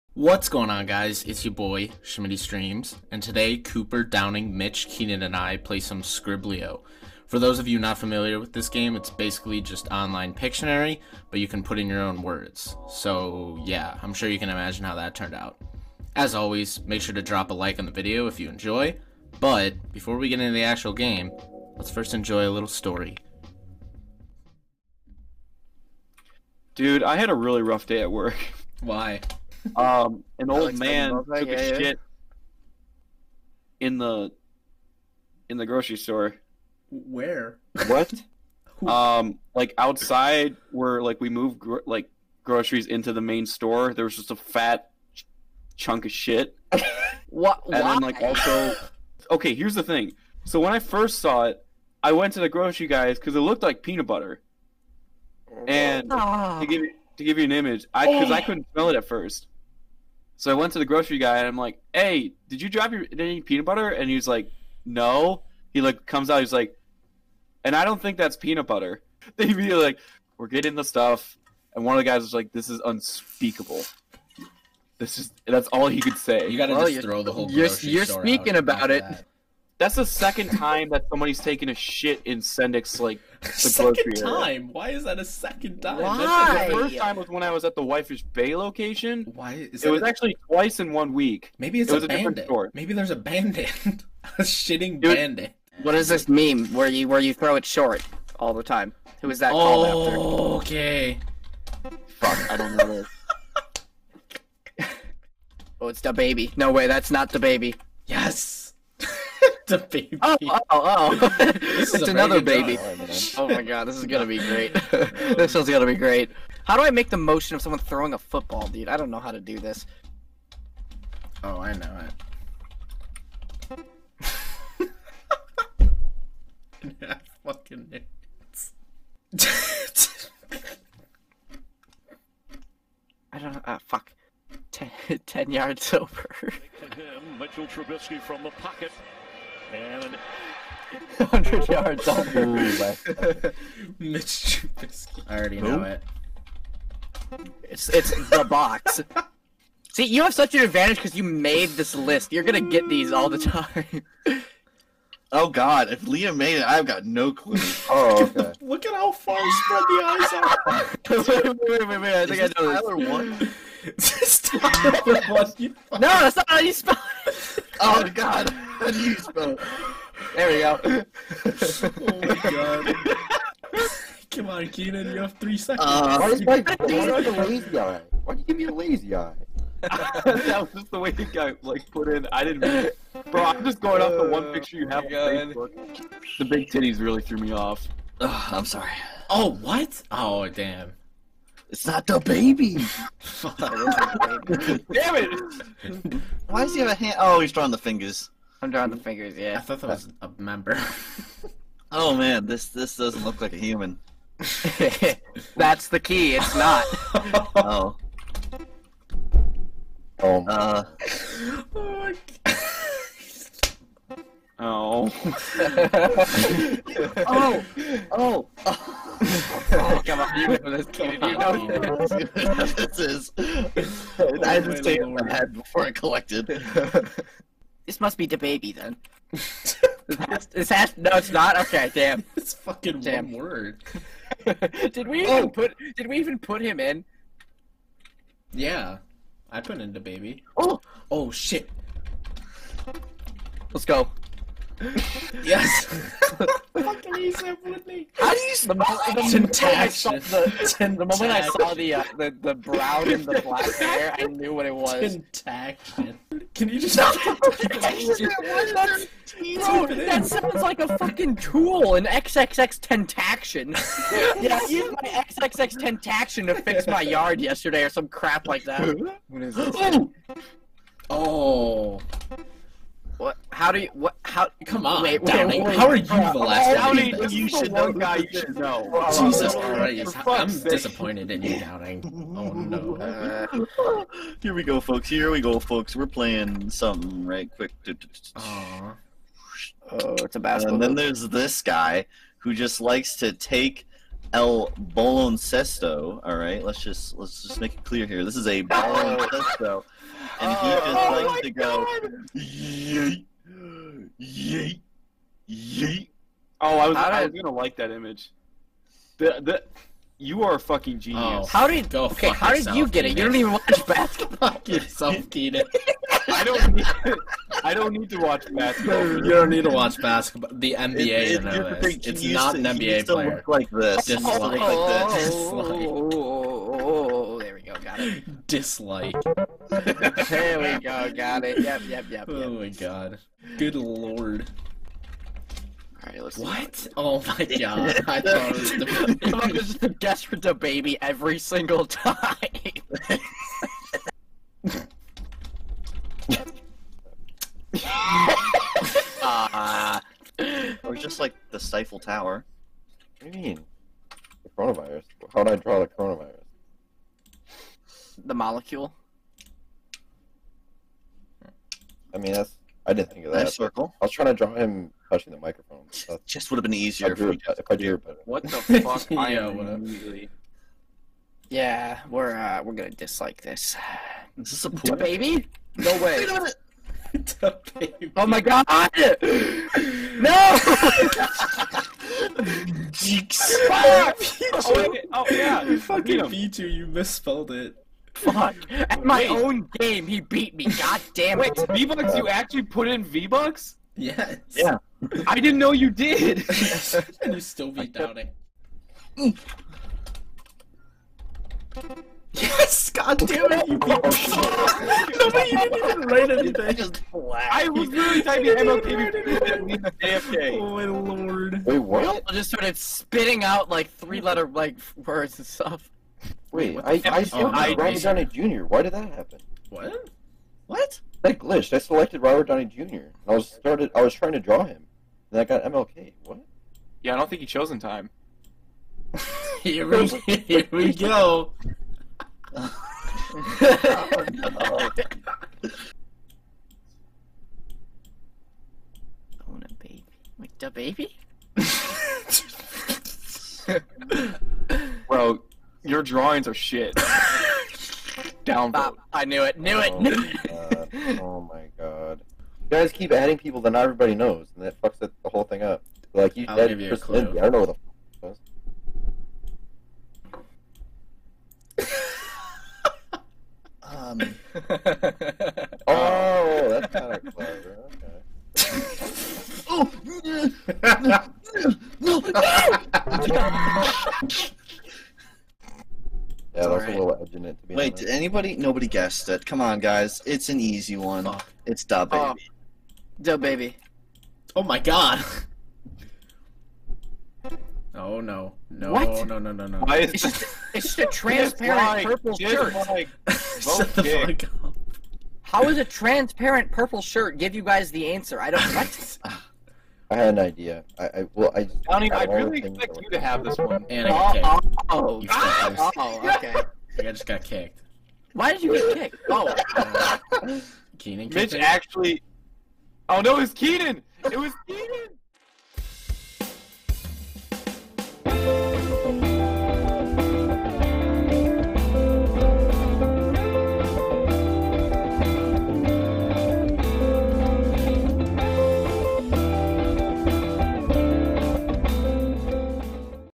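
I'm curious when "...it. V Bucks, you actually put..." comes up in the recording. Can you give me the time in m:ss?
6:31.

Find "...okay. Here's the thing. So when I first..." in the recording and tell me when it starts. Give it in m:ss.
0:49.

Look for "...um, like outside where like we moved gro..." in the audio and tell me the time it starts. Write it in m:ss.
0:38.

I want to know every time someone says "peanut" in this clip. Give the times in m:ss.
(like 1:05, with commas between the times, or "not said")
0:53, 1:03, 1:08.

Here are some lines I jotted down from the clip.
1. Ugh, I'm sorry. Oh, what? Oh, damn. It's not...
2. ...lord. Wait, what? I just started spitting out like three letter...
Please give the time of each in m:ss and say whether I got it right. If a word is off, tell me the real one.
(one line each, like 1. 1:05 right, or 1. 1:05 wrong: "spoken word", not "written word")
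1. 3:08 right
2. 6:50 right.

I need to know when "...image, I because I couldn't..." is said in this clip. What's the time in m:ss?
0:57.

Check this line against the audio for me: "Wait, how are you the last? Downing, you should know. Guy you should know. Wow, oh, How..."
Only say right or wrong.
wrong.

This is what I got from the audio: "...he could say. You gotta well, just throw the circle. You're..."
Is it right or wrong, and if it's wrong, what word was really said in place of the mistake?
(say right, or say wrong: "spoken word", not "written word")
wrong: "whole", not "circle".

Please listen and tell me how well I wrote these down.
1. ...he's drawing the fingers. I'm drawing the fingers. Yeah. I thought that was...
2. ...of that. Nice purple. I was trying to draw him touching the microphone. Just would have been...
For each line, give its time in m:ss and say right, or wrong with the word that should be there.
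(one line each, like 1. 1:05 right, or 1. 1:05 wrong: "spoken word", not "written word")
1. 3:17 right
2. 6:03 wrong: "circle", not "purple".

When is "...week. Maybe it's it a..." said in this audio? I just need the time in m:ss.
1:31.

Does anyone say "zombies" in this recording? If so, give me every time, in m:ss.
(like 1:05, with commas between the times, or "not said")
not said.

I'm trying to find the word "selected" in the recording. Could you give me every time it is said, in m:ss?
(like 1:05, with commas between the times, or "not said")
7:01.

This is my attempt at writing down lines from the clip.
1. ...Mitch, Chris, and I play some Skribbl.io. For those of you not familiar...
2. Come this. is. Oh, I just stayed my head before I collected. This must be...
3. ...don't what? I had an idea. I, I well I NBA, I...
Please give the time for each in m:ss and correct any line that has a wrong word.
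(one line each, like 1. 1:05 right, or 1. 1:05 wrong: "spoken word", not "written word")
1. 0:04 wrong: "Keenan", not "Chris"
2. 3:42 right
3. 8:18 wrong: "Johnny", not "NBA".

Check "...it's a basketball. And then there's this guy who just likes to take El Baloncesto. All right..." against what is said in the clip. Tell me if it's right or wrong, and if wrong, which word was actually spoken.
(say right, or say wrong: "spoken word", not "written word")
right.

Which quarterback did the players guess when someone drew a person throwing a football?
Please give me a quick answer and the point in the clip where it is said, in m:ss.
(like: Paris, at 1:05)
Mitchell Trubisky, at 2:17.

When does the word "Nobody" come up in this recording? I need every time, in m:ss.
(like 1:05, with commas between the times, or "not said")
6:45, 7:58.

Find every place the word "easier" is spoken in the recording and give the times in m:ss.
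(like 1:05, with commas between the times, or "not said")
6:06.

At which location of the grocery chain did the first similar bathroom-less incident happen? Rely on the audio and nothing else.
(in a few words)
Whitefish Bay.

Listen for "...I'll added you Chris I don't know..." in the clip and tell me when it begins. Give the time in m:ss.
7:36.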